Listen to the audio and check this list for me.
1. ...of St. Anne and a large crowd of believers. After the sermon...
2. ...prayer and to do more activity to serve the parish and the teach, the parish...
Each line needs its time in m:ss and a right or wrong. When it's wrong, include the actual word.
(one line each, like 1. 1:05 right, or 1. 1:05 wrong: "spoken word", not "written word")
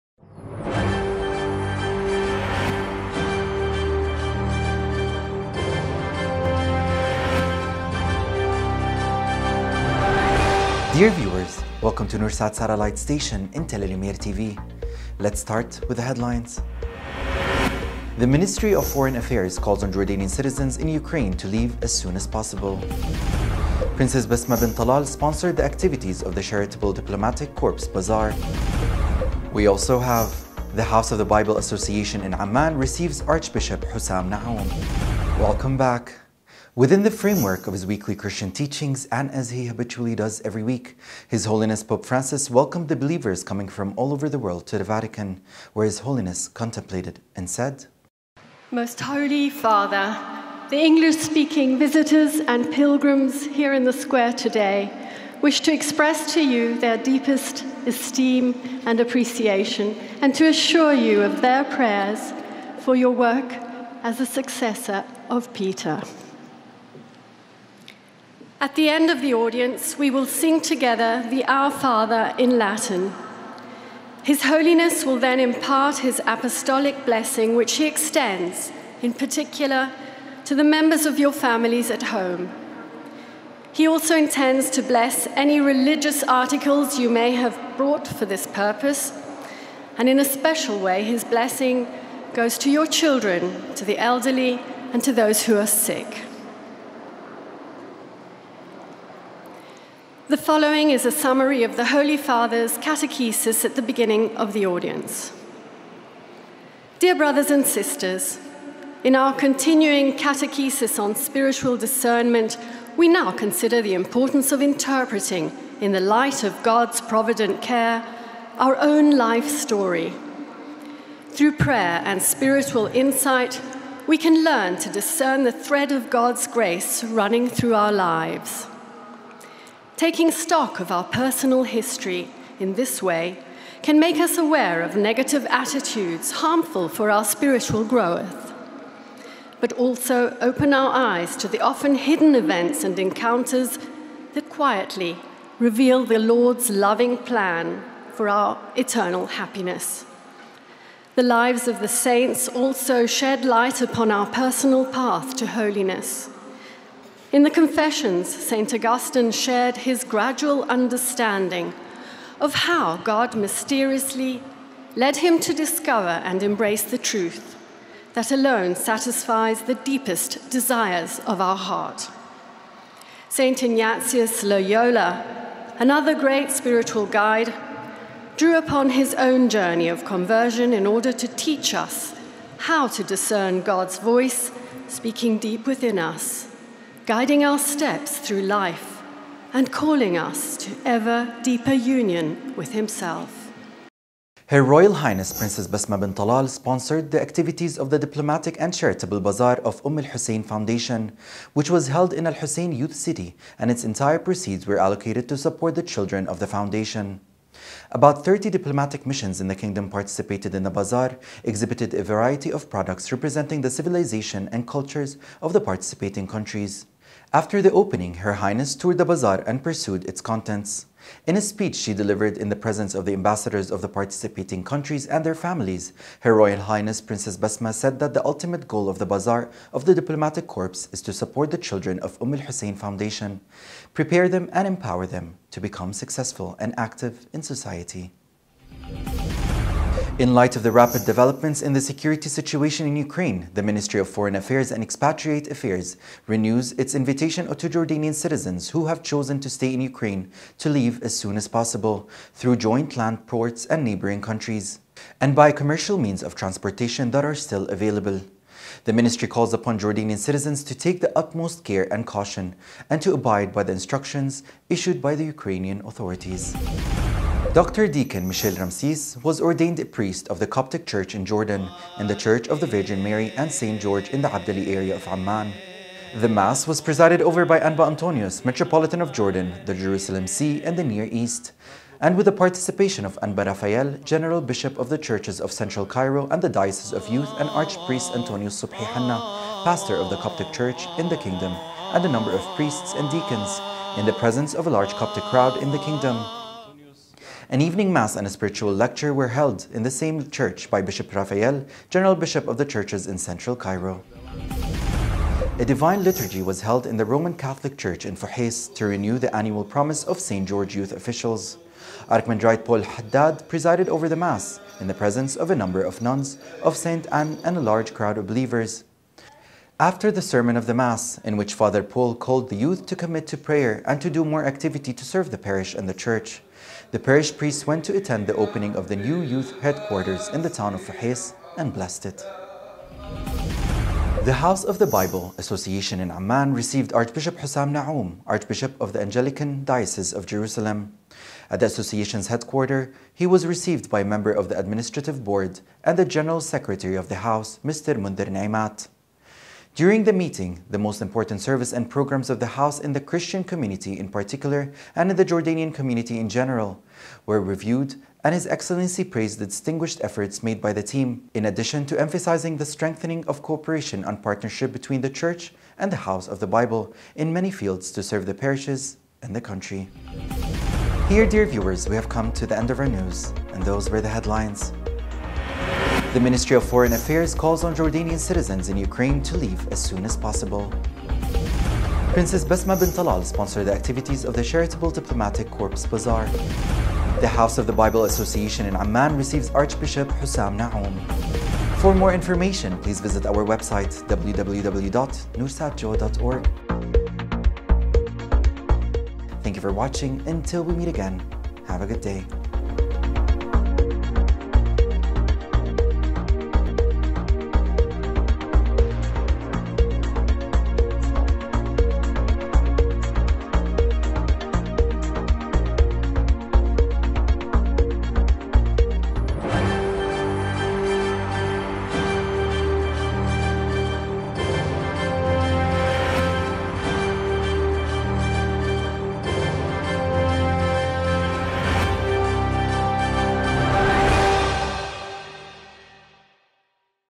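1. 5:16 right
2. 5:23 wrong: "church", not "teach".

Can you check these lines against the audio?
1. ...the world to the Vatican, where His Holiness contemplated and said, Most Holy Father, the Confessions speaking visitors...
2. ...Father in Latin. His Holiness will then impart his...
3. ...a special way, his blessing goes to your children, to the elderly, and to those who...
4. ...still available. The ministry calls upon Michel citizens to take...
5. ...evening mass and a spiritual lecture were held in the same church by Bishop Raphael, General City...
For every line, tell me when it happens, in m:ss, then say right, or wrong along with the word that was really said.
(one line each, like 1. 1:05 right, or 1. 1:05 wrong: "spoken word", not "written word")
1. 0:44 wrong: "English", not "Confessions"
2. 1:11 right
3. 1:30 right
4. 4:17 wrong: "Jordanian", not "Michel"
5. 4:57 wrong: "Bishop", not "City".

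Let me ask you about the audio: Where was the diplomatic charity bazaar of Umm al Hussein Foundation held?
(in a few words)
Al Hussein Youth City.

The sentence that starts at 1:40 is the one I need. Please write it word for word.
The following is a summary of the Holy Father's catechesis at the beginning of the audience.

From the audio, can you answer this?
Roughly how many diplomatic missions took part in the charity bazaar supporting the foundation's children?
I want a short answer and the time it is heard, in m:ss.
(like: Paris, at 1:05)
30, at 3:28.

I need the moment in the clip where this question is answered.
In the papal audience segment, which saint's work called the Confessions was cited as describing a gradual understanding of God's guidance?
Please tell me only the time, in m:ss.
2:38.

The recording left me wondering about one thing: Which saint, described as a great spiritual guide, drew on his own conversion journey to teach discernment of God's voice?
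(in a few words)
St. Ignatius Loyola.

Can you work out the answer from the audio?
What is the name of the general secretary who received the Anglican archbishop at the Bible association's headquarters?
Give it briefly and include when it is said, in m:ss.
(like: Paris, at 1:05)
Mundir Naimat, at 5:47.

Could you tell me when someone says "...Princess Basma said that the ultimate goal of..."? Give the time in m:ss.
3:46.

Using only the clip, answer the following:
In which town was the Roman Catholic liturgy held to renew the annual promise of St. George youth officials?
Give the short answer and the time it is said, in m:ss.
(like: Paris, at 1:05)
Fuhais, at 5:08.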